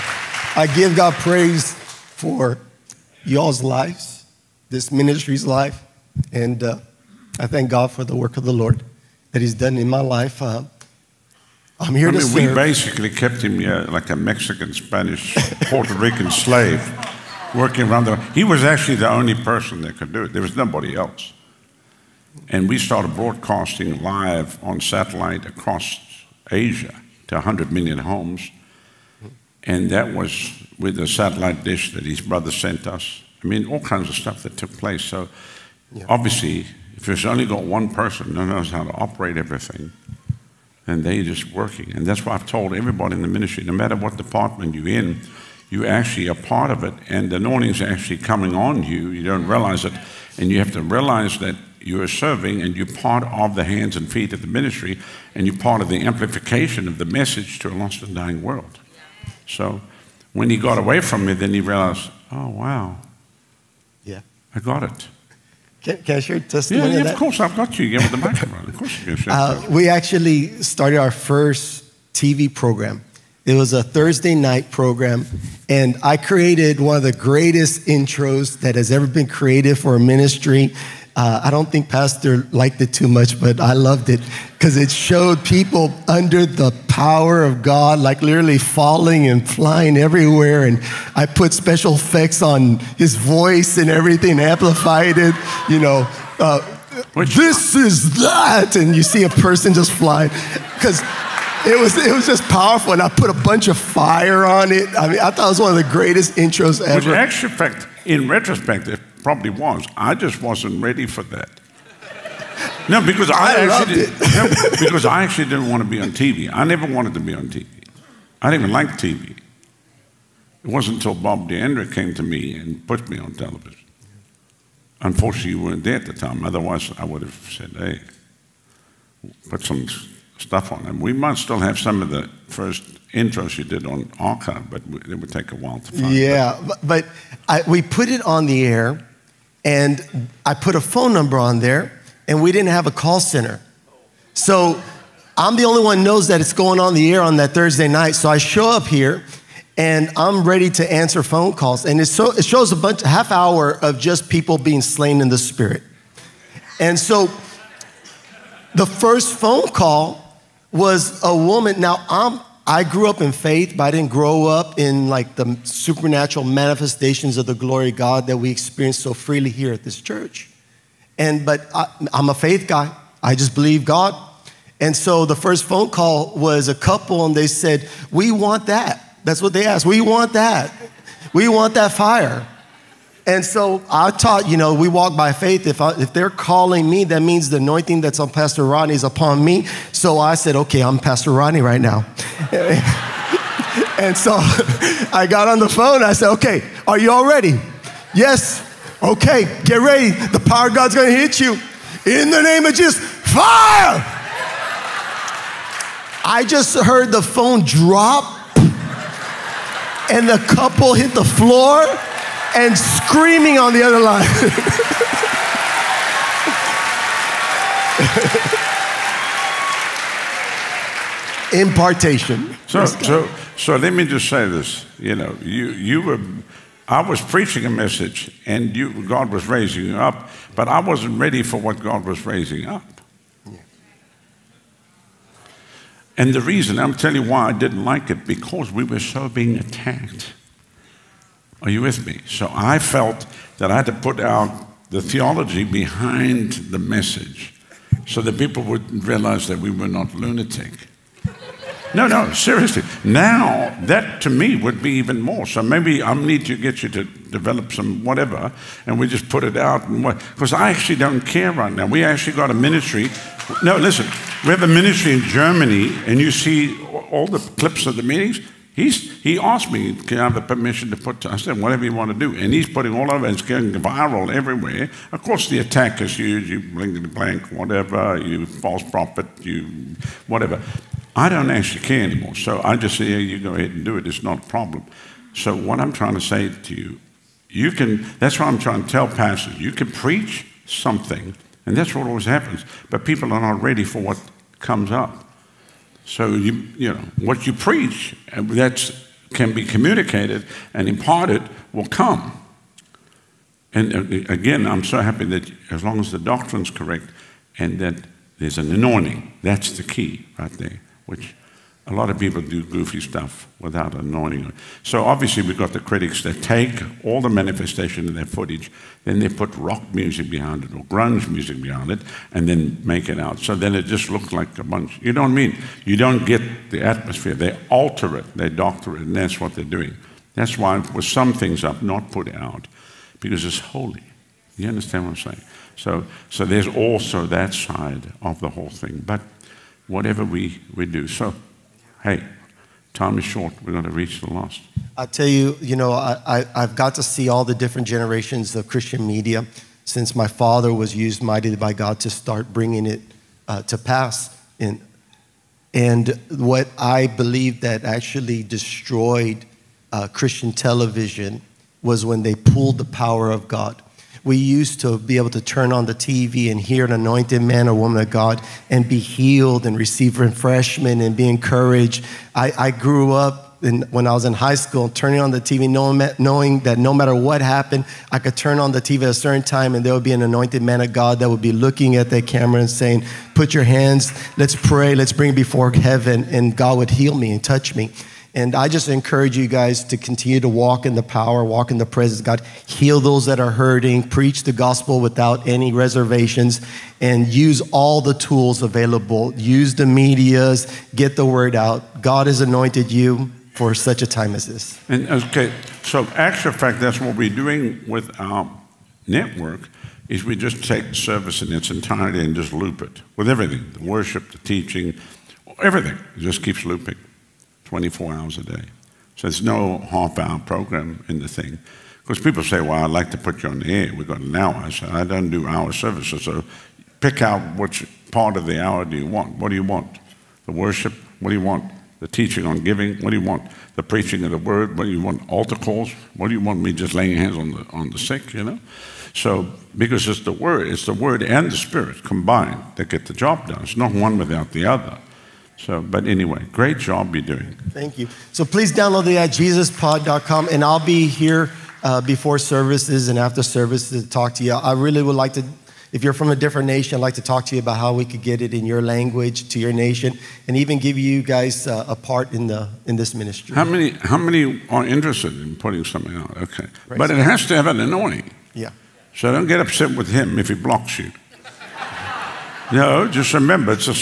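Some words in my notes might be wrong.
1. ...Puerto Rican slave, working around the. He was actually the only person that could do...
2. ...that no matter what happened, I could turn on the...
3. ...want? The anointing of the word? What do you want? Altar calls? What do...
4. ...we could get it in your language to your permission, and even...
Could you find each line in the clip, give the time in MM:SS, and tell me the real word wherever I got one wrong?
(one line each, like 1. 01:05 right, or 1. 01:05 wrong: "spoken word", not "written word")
1. 00:15 right
2. 06:16 right
3. 07:13 wrong: "preaching", not "anointing"
4. 07:37 wrong: "nation", not "permission".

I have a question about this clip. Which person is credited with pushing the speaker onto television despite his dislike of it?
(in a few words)
Bob DeAndre.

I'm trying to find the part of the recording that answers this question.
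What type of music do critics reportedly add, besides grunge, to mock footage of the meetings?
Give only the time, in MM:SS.
05:19.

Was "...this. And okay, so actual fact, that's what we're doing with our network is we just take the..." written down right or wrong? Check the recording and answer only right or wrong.
right.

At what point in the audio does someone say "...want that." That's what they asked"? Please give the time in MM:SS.
02:58.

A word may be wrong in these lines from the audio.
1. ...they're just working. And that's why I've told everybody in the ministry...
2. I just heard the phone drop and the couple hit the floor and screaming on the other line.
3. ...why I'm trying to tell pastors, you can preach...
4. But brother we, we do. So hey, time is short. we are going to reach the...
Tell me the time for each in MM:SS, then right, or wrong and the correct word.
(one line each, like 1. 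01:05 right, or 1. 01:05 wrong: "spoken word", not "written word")
1. 00:41 right
2. 03:26 right
3. 04:48 right
4. 05:39 wrong: "whatever", not "brother".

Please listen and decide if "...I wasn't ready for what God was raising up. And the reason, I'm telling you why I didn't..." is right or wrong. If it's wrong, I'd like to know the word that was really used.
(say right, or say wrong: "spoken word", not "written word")
right.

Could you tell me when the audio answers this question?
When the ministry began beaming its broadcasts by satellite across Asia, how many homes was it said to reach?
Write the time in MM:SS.
00:27.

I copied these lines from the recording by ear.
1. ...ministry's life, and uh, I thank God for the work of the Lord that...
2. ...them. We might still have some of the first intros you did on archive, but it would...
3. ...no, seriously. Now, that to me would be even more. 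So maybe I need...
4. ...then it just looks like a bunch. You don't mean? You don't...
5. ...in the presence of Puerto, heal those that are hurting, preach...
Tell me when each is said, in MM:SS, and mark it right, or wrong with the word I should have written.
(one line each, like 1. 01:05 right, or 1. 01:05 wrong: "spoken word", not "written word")
1. 00:04 right
2. 02:10 right
3. 04:12 right
4. 05:23 right
5. 06:31 wrong: "God", not "Puerto".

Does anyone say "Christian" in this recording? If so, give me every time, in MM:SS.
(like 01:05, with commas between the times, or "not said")
05:48, 06:00.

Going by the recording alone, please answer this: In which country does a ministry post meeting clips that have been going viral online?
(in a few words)
Germany.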